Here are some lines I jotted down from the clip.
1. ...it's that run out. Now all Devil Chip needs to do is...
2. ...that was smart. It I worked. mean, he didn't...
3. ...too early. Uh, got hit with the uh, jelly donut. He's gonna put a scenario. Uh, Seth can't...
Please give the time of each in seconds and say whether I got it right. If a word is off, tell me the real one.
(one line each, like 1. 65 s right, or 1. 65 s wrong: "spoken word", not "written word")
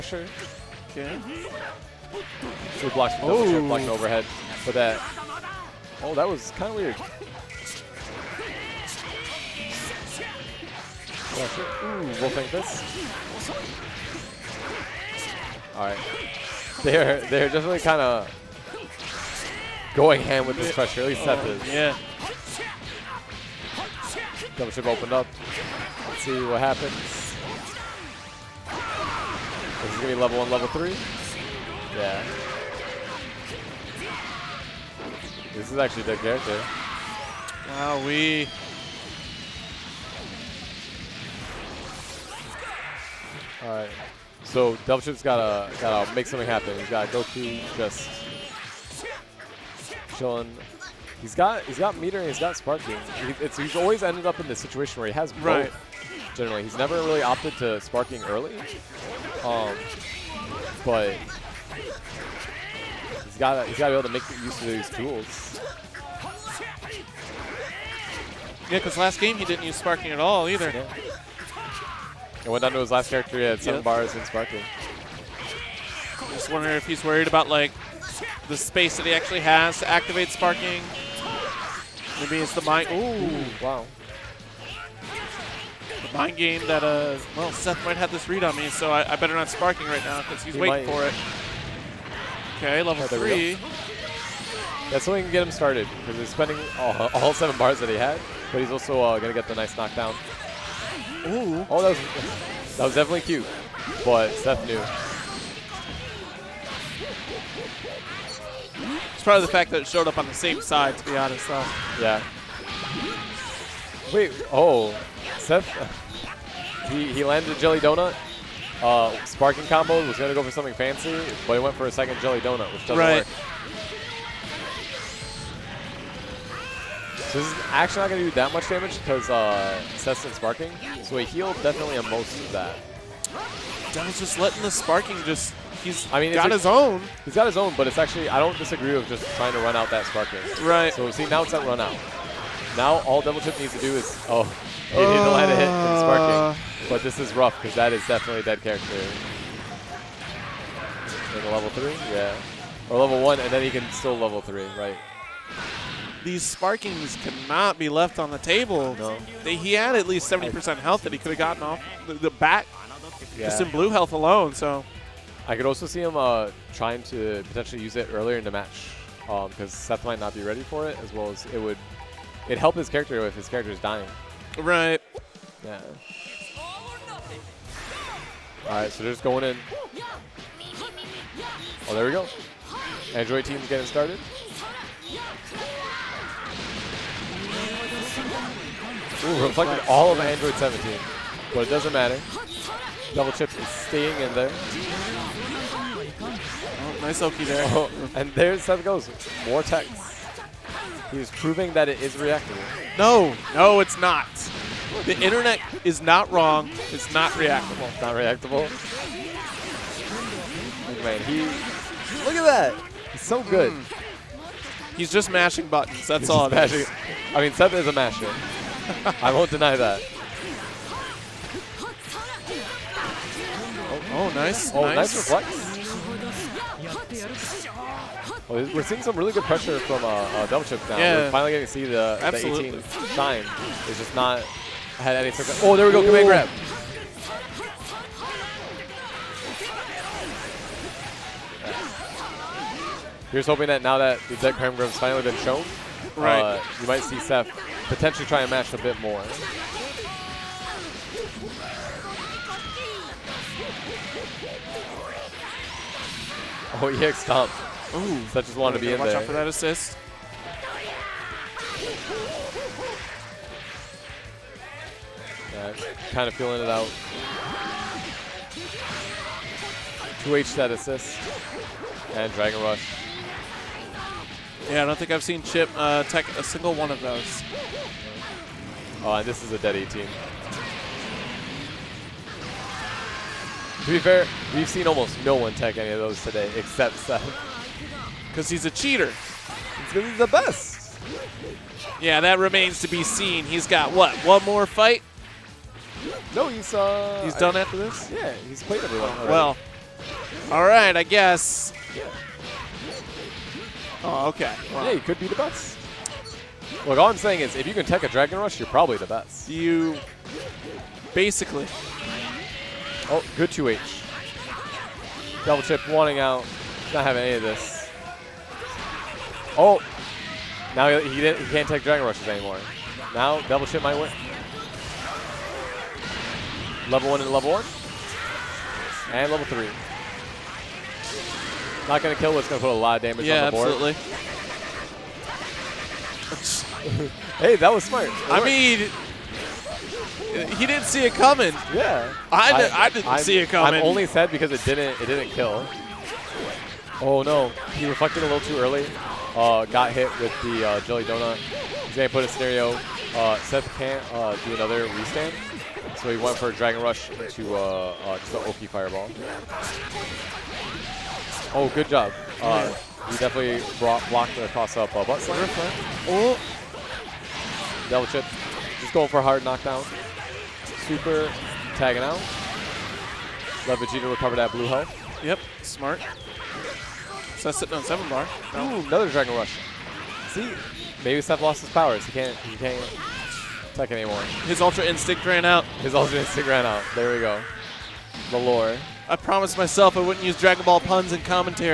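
1. 141 s right
2. 337 s right
3. 348 s right.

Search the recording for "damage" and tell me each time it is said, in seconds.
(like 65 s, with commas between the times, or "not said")
128 s, 333 s.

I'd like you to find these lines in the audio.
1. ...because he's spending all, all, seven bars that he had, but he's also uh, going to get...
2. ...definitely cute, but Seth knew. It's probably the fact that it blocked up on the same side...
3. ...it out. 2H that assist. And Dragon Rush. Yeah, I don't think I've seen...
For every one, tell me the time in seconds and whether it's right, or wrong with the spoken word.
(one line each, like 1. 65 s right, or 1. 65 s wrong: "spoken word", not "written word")
1. 95 s right
2. 102 s wrong: "showed", not "blocked"
3. 266 s right.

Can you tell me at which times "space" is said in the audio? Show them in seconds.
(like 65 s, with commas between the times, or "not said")
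78 s.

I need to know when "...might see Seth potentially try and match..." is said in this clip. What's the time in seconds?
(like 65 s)
246 s.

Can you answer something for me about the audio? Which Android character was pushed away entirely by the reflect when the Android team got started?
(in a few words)
Android 17.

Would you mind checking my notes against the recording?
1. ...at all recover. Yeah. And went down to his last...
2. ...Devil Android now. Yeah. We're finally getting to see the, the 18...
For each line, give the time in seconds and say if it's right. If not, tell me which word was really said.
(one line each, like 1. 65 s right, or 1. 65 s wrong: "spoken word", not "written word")
1. 70 s wrong: "either", not "recover"
2. 230 s wrong: "Chip", not "Android".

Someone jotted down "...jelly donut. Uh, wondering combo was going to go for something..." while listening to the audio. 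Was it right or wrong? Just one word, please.
wrong.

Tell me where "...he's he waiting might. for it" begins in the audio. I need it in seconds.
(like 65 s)
90 s.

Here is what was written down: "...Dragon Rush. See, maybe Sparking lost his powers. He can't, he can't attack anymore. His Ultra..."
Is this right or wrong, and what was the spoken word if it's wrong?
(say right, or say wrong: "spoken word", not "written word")
wrong: "Seth", not "Sparking".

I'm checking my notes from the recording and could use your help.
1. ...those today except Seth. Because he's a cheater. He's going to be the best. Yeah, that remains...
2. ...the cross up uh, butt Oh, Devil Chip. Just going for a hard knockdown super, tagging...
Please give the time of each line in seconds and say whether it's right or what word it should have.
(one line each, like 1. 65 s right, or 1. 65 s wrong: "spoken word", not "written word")
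1. 285 s right
2. 364 s right.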